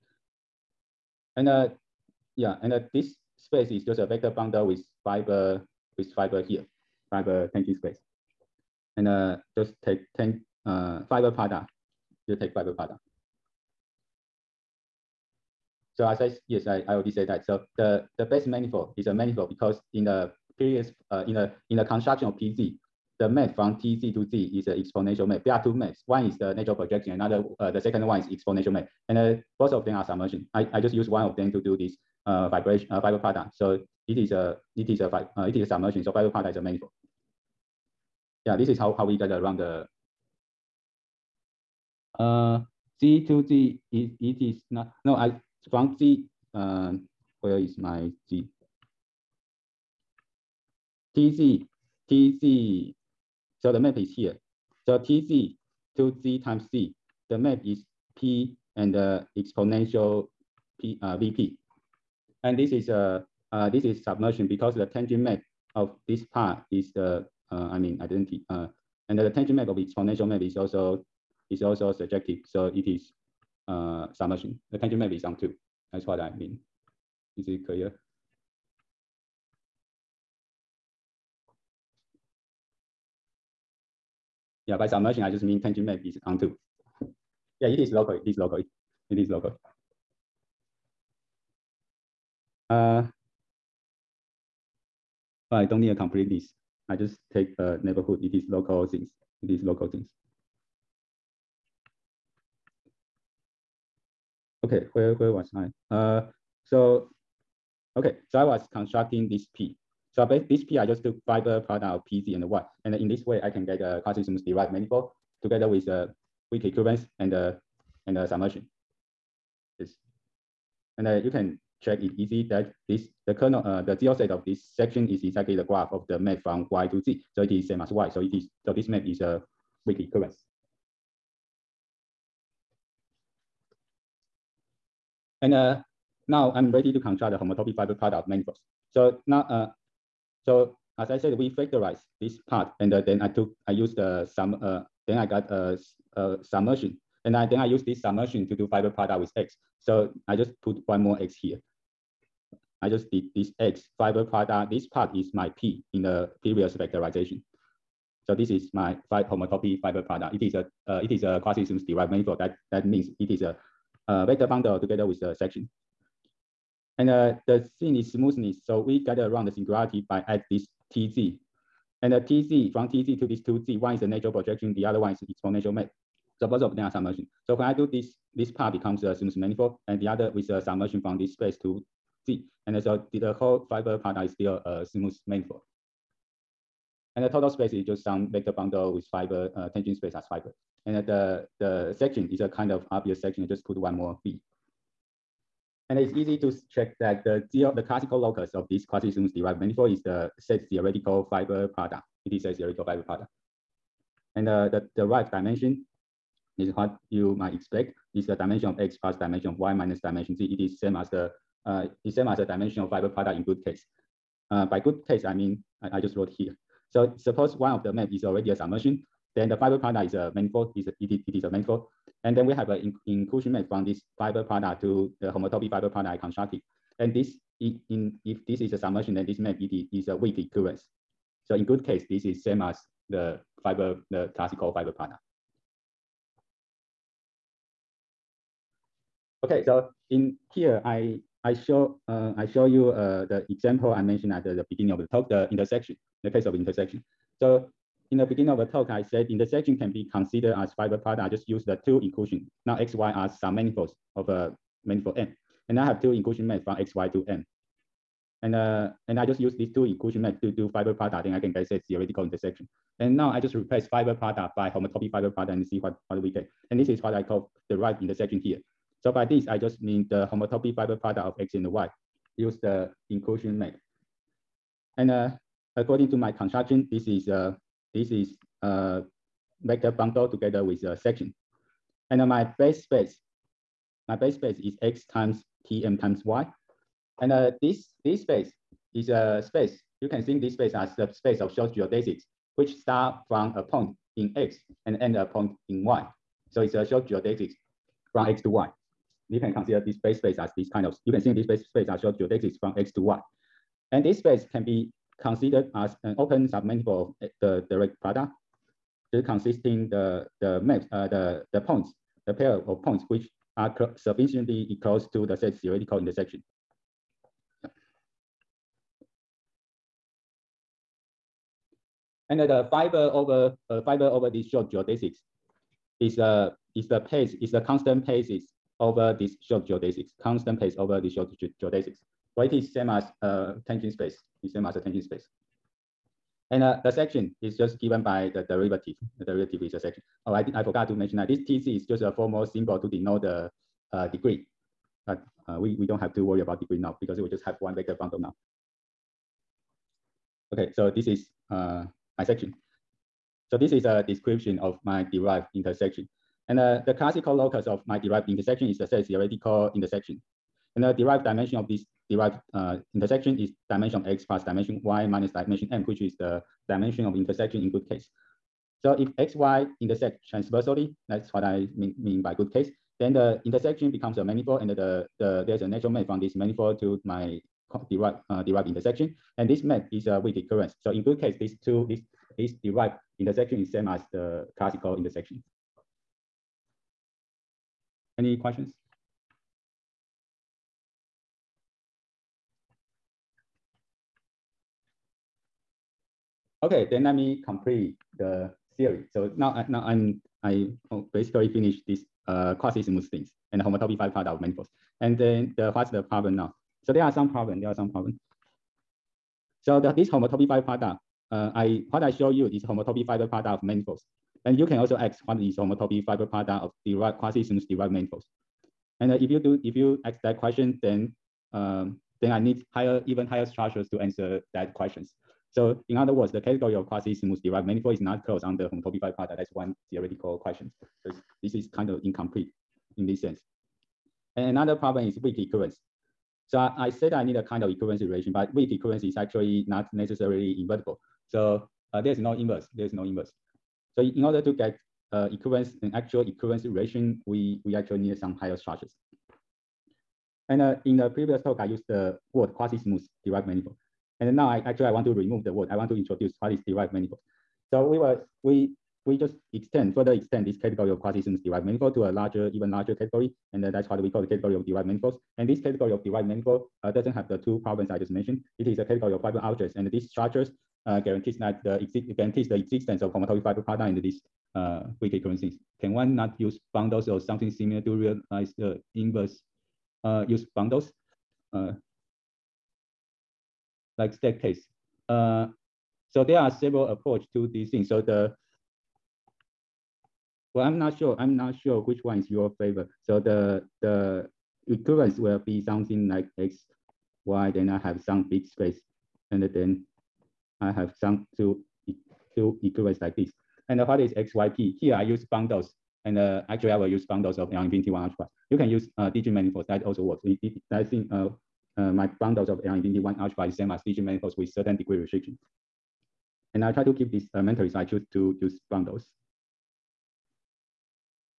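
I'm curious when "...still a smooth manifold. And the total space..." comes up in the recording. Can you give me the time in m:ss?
3:04.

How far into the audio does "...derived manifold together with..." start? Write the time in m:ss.
1:54.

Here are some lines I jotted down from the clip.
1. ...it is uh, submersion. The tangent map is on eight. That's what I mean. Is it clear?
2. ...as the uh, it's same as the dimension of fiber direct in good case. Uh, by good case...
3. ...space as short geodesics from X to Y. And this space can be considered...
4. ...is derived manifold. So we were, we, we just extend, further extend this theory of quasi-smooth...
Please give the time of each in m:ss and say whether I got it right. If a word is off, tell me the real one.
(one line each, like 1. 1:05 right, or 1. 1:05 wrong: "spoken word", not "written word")
1. 1:12 wrong: "two", not "eight"
2. 3:30 wrong: "product", not "direct"
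3. 5:01 right
4. 7:36 wrong: "category", not "theory".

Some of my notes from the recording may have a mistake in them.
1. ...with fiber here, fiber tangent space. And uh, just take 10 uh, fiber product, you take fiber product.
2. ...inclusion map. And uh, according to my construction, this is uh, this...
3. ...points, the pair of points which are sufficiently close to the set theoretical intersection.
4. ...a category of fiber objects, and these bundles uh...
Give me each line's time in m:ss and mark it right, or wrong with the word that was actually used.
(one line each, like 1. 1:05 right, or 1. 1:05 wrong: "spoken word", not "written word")
1. 0:05 right
2. 4:33 right
3. 5:11 right
4. 7:48 wrong: "structures", not "bundles".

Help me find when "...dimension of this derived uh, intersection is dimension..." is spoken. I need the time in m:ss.
6:01.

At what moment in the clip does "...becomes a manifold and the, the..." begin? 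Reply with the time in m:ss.
6:13.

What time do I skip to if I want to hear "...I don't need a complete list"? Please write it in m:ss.
1:35.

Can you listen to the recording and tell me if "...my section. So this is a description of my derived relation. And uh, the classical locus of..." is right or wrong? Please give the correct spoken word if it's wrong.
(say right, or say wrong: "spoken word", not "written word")
wrong: "intersection", not "relation".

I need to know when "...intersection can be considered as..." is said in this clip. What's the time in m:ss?
4:09.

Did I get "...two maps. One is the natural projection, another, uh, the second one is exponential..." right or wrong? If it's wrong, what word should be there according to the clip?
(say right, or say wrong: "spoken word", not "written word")
right.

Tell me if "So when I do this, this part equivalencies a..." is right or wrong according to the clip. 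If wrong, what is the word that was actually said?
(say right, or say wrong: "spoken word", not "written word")
wrong: "becomes", not "equivalencies".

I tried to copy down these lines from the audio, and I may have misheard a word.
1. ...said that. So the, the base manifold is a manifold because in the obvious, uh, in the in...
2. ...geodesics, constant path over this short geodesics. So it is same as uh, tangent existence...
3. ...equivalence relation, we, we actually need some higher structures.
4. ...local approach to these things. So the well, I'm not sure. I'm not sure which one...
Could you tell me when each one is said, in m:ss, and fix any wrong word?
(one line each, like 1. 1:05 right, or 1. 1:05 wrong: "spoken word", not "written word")
1. 0:17 wrong: "previous", not "obvious"
2. 5:29 wrong: "space", not "existence"
3. 7:26 right
4. 8:06 wrong: "several", not "local".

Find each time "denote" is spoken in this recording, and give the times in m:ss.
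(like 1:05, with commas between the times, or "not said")
5:42.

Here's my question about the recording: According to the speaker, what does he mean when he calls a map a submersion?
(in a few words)
tangent map is onto.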